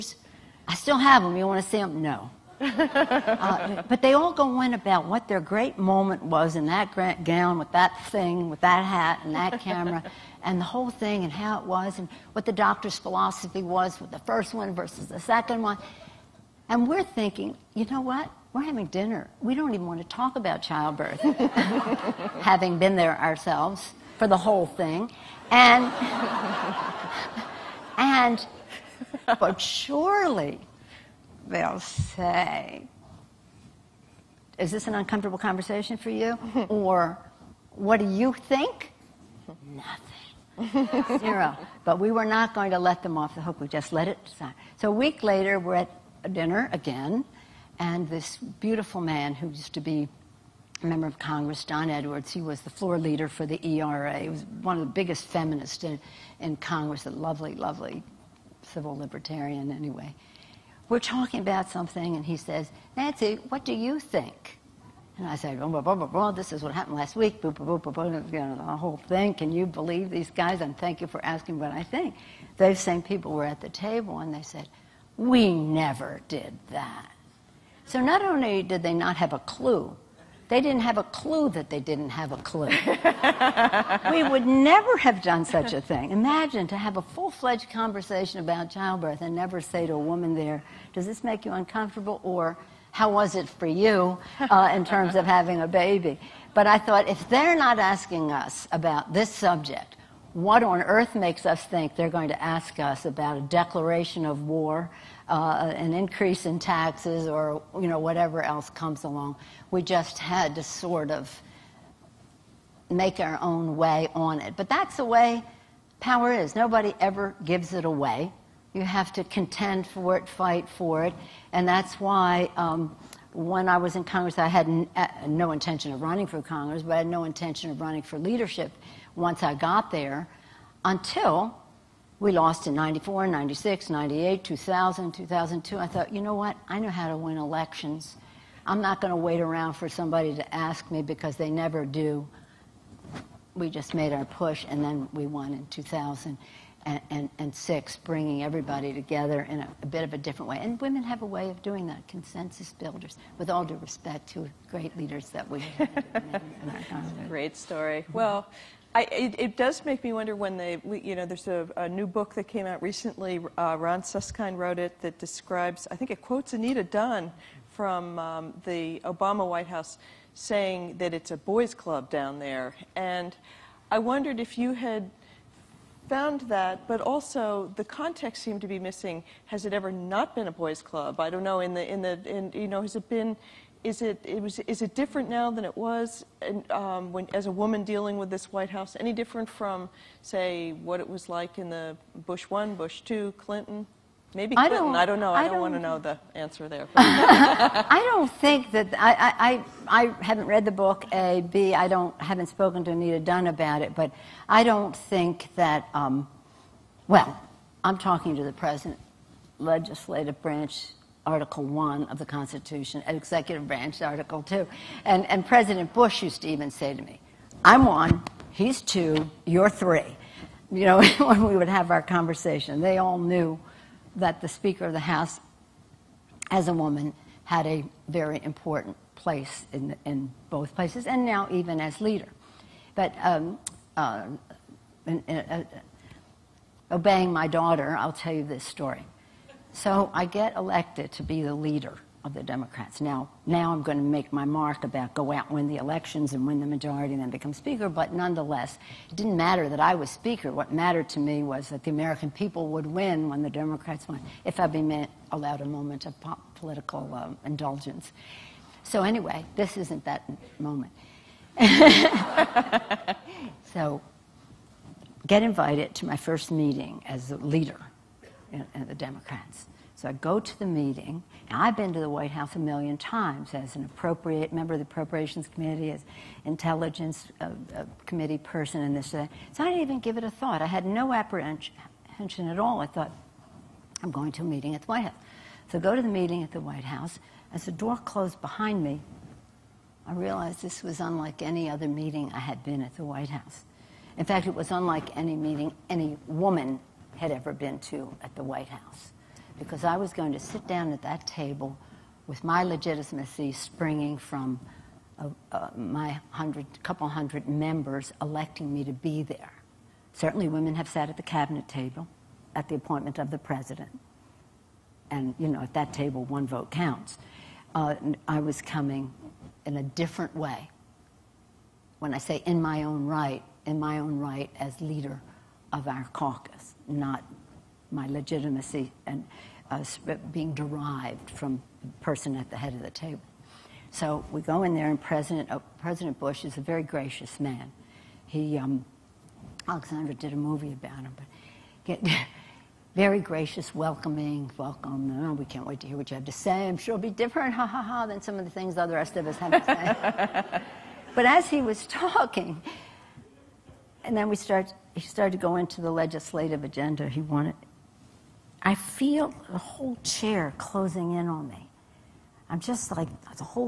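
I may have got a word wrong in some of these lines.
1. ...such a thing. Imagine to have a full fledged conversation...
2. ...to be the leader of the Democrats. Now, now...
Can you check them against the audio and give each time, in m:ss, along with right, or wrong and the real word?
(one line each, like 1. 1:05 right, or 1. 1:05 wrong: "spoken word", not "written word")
1. 1:25 right
2. 4:01 right.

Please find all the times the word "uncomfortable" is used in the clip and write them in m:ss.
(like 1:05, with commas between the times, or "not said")
0:34, 1:31.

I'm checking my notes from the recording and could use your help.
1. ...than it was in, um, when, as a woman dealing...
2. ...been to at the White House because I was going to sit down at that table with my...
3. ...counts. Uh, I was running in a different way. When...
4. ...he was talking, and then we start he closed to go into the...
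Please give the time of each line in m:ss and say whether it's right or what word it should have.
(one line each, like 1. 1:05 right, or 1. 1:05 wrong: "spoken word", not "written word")
1. 3:05 right
2. 4:57 right
3. 5:16 wrong: "coming", not "running"
4. 5:51 wrong: "started", not "closed".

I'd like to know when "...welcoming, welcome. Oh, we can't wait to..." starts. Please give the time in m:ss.
5:43.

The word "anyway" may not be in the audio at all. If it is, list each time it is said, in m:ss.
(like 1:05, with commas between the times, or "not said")
0:59, 4:19.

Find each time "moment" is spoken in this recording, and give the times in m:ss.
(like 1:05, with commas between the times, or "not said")
0:05, 4:15, 4:20.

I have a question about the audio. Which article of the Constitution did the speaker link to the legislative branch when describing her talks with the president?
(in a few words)
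Article 1.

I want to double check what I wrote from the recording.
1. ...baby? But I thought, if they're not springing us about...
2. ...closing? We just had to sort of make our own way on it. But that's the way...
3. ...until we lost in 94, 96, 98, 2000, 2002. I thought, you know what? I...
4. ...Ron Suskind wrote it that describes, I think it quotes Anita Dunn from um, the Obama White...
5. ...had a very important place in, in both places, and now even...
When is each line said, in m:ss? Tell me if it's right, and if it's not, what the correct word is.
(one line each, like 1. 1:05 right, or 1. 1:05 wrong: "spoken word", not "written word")
1. 1:35 wrong: "asking", not "springing"
2. 1:49 wrong: "along", not "closing"
3. 2:10 right
4. 2:43 right
5. 3:47 right.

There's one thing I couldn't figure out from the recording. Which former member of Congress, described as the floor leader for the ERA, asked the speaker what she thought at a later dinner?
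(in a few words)
Don Edwards.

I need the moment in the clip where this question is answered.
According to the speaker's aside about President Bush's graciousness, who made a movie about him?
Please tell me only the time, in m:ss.
5:39.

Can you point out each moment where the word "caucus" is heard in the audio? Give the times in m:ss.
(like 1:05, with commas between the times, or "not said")
5:26.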